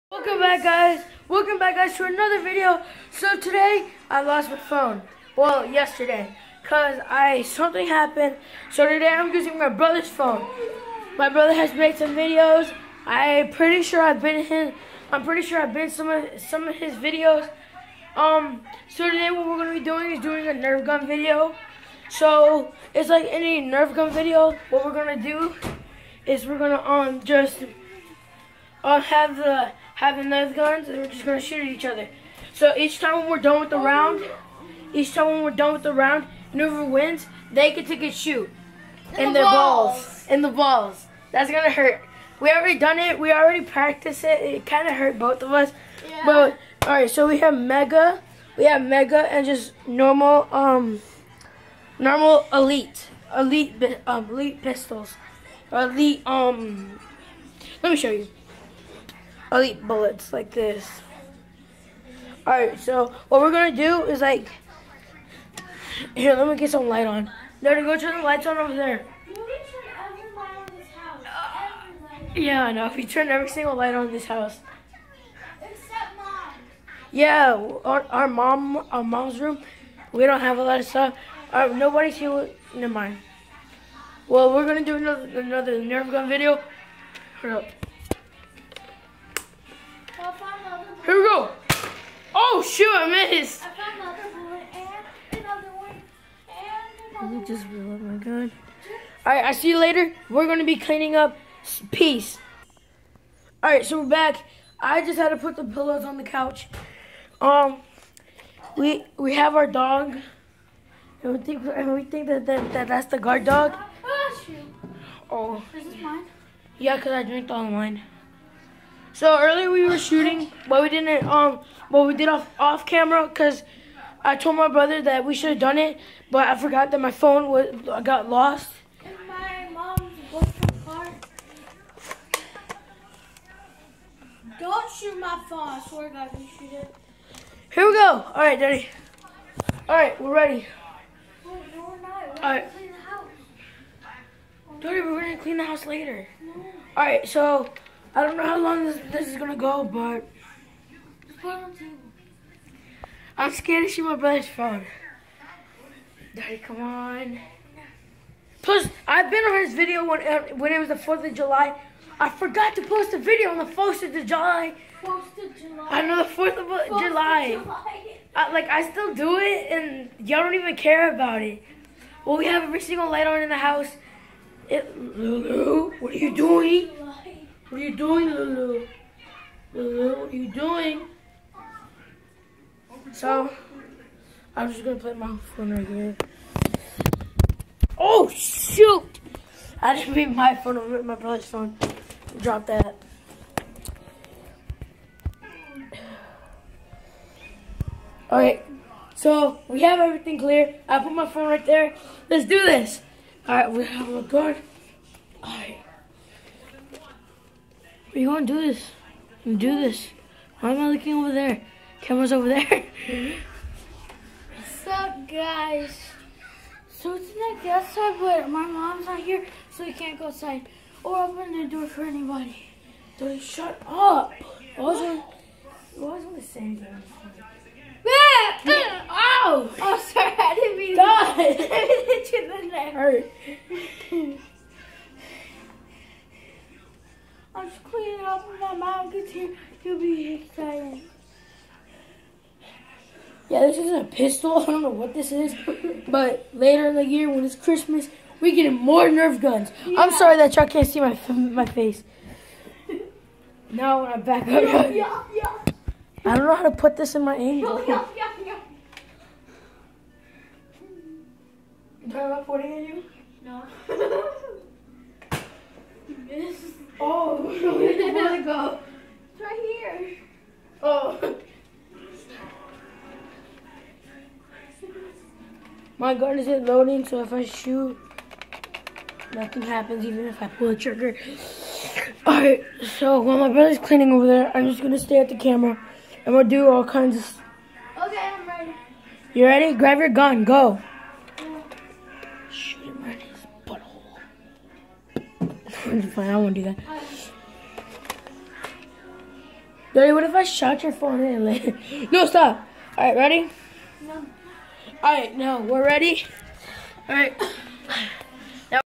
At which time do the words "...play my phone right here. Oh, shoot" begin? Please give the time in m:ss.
3:04.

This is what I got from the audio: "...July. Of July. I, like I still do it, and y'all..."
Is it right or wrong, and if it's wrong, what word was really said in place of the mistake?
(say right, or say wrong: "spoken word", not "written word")
right.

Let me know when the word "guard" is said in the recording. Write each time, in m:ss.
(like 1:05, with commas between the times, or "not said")
1:53, 3:24.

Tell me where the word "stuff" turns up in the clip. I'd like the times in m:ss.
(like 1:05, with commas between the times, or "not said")
1:20.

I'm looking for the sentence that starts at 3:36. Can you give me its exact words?
So tonight, the outside, but my mom's not here, so we can't go outside or open the door for anybody.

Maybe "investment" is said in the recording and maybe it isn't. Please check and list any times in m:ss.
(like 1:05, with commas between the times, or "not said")
not said.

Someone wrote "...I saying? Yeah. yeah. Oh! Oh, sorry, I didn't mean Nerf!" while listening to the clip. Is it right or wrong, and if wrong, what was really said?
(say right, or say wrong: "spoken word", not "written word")
wrong: "God", not "Nerf".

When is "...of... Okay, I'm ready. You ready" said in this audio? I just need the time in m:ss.
4:47.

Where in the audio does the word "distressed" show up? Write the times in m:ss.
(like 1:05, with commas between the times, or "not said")
not said.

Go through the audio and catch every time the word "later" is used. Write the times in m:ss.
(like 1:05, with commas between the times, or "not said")
1:39, 2:25, 4:06, 5:01.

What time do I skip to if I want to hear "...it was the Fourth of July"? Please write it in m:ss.
2:40.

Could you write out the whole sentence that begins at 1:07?
No, go turn the lights on over there.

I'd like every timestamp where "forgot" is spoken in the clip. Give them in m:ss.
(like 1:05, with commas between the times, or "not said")
2:06, 2:42.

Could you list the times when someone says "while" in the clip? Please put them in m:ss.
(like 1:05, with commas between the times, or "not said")
4:43.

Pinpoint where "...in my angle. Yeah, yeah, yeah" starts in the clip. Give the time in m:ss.
4:17.